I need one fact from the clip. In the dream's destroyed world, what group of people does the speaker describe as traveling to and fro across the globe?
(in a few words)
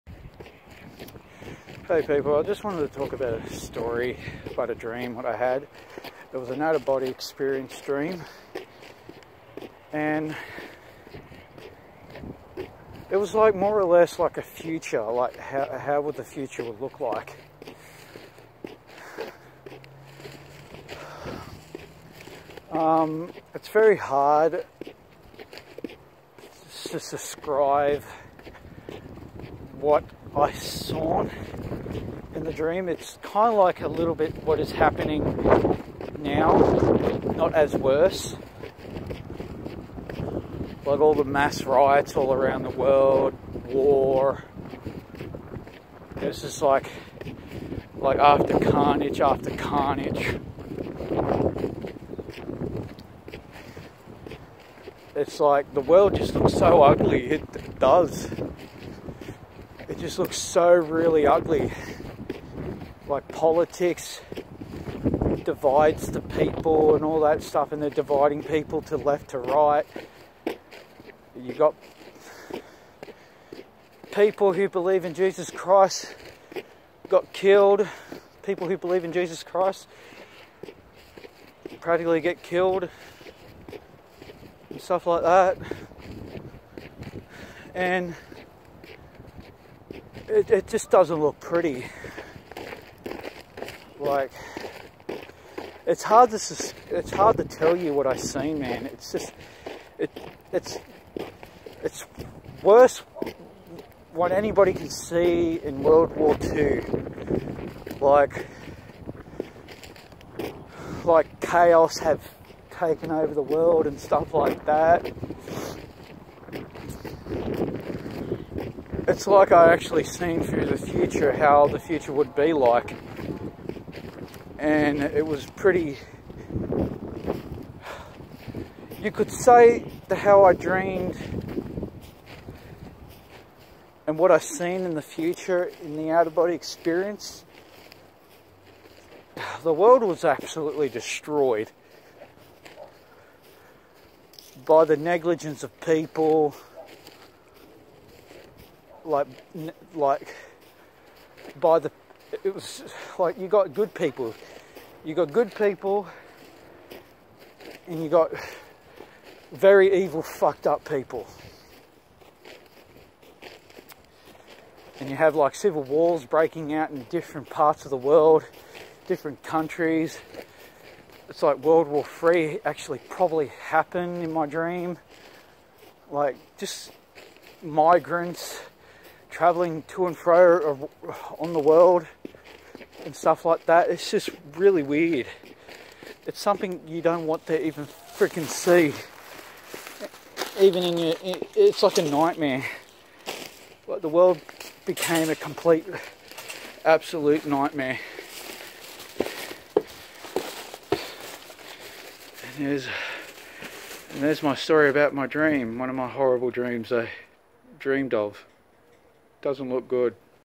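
migrants.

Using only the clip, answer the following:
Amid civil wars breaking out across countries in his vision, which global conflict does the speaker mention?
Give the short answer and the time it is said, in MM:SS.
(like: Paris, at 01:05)
World War 3, at 02:51.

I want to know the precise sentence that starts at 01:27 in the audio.
And it, it just doesn't look pretty.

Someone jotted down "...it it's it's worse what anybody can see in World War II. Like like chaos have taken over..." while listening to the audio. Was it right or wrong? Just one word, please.
right.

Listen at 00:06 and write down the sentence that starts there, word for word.
It was an out-of-body experience dream.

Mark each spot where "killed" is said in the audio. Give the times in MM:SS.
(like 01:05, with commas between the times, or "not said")
01:17, 01:22.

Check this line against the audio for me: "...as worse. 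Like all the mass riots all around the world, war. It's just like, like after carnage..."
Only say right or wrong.
right.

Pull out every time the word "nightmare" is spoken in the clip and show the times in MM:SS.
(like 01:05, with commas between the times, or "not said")
03:12, 03:17.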